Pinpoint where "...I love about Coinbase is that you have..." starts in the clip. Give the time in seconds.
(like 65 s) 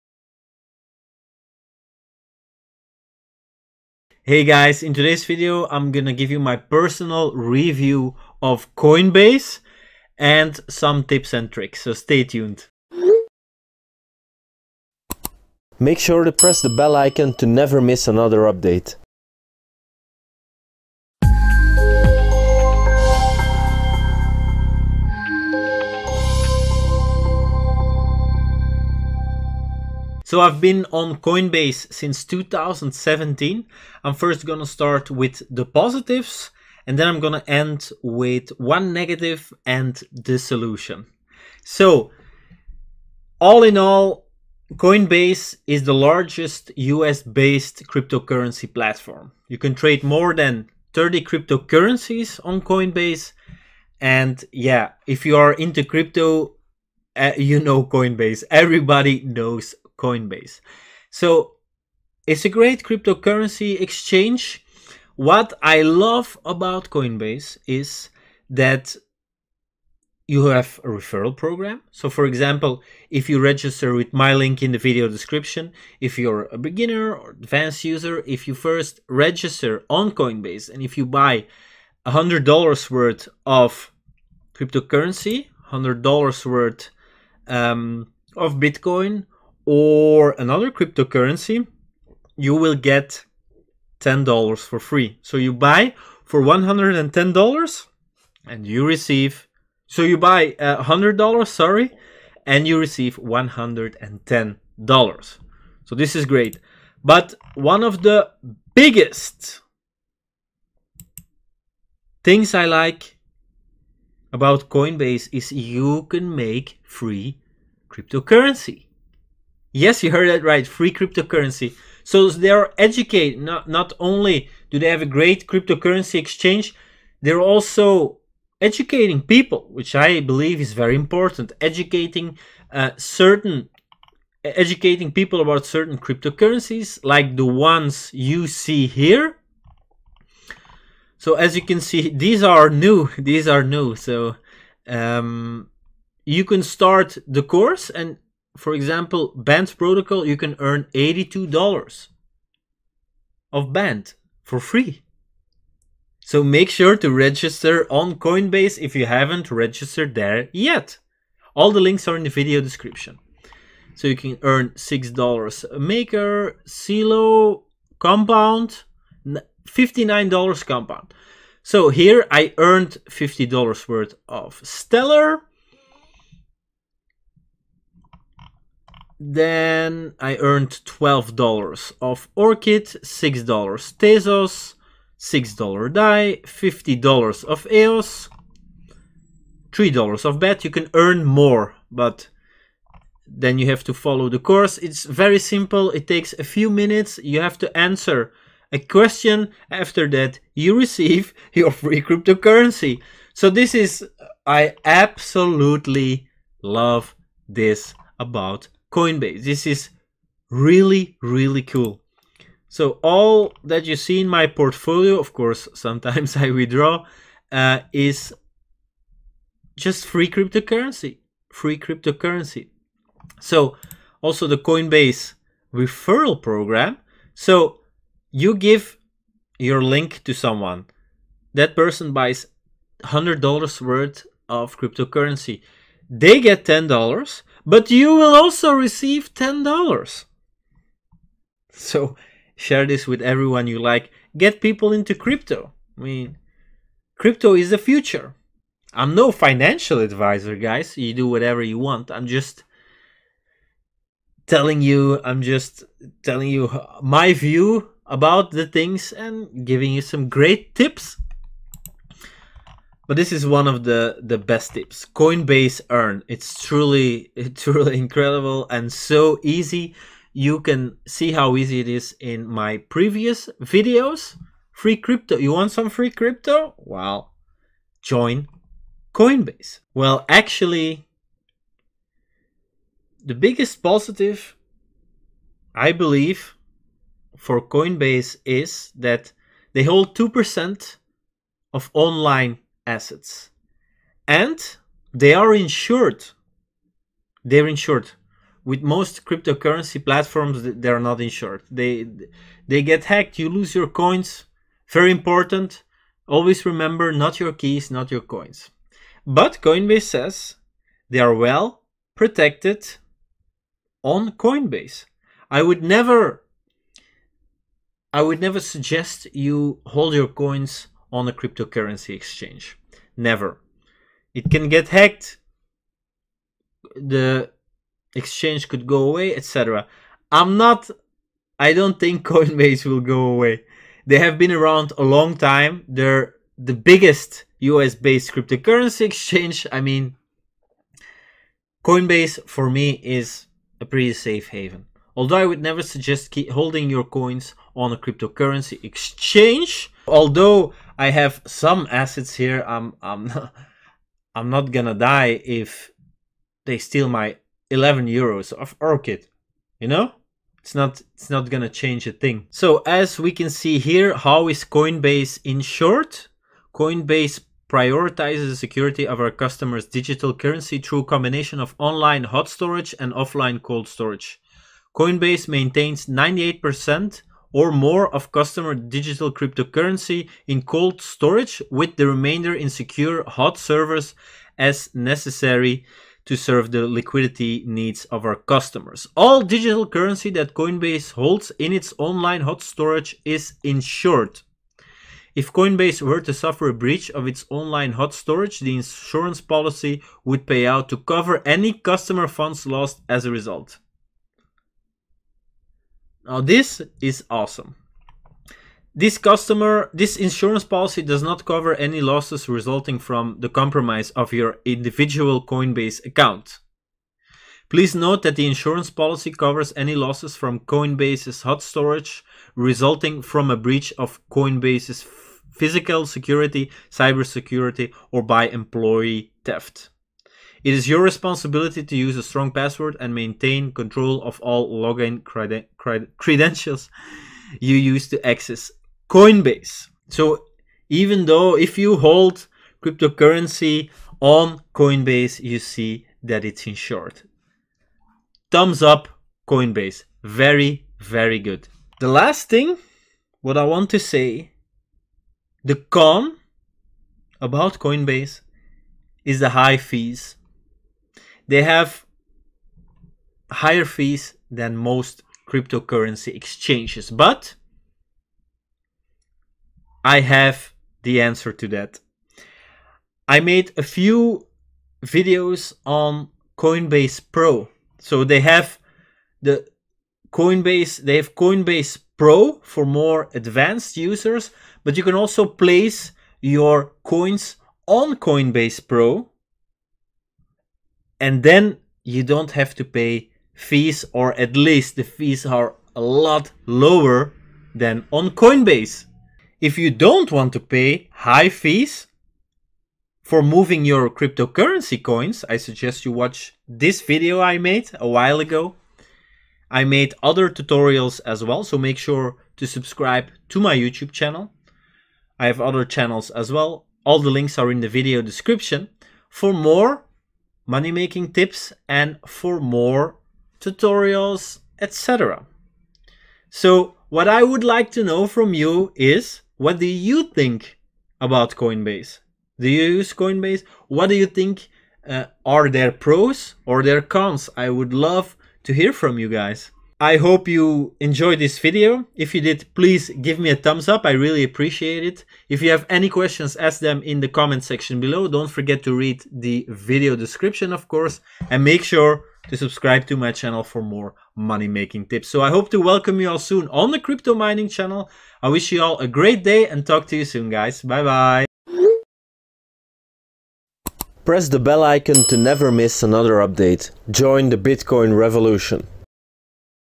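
65 s.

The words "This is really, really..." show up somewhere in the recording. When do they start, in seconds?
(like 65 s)
209 s.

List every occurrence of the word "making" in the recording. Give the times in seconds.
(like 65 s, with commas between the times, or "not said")
520 s, 554 s.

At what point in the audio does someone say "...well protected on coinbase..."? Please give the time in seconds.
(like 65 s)
311 s.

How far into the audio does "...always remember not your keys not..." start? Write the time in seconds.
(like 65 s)
306 s.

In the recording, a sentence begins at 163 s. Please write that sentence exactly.
So you can earn $6 maker, Celo, compound, $59 compound.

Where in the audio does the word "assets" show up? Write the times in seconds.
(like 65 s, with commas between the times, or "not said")
292 s, 351 s.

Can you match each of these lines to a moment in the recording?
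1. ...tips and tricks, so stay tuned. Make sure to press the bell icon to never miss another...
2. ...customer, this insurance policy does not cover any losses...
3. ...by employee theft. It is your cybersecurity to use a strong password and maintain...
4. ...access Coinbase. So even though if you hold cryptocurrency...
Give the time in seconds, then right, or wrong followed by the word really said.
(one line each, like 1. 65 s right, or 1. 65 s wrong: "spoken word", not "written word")
1. 11 s right
2. 409 s right
3. 428 s wrong: "responsibility", not "cybersecurity"
4. 438 s right.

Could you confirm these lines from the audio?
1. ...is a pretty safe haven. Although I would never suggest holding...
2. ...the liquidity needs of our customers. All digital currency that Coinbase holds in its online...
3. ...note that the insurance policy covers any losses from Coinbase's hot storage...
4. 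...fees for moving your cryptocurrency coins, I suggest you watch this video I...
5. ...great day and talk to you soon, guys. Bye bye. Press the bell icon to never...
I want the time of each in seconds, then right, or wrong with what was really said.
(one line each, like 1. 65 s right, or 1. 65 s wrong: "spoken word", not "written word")
1. 343 s right
2. 386 s right
3. 417 s right
4. 501 s right
5. 559 s right.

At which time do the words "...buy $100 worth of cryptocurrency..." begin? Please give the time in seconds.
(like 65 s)
81 s.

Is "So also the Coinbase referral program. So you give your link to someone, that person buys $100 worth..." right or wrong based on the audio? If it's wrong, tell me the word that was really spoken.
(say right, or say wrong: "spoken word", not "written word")
right.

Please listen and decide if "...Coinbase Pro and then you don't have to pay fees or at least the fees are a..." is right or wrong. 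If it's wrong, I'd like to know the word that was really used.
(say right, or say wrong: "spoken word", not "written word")
right.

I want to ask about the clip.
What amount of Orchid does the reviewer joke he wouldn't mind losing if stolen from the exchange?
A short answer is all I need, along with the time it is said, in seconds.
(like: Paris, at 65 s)
11 euros, at 357 s.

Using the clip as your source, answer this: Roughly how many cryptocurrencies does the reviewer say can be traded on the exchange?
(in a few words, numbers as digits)
more than 30.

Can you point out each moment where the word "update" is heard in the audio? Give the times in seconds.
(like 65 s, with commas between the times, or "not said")
18 s, 566 s.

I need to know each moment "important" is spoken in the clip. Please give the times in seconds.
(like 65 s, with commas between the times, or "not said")
130 s, 305 s.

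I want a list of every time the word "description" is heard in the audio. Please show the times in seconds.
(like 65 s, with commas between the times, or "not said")
75 s, 162 s, 518 s, 550 s.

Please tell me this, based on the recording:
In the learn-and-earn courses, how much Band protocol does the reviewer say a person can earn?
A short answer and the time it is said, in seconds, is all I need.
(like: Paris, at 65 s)
$82, at 150 s.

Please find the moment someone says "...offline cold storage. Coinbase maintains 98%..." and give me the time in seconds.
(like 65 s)
373 s.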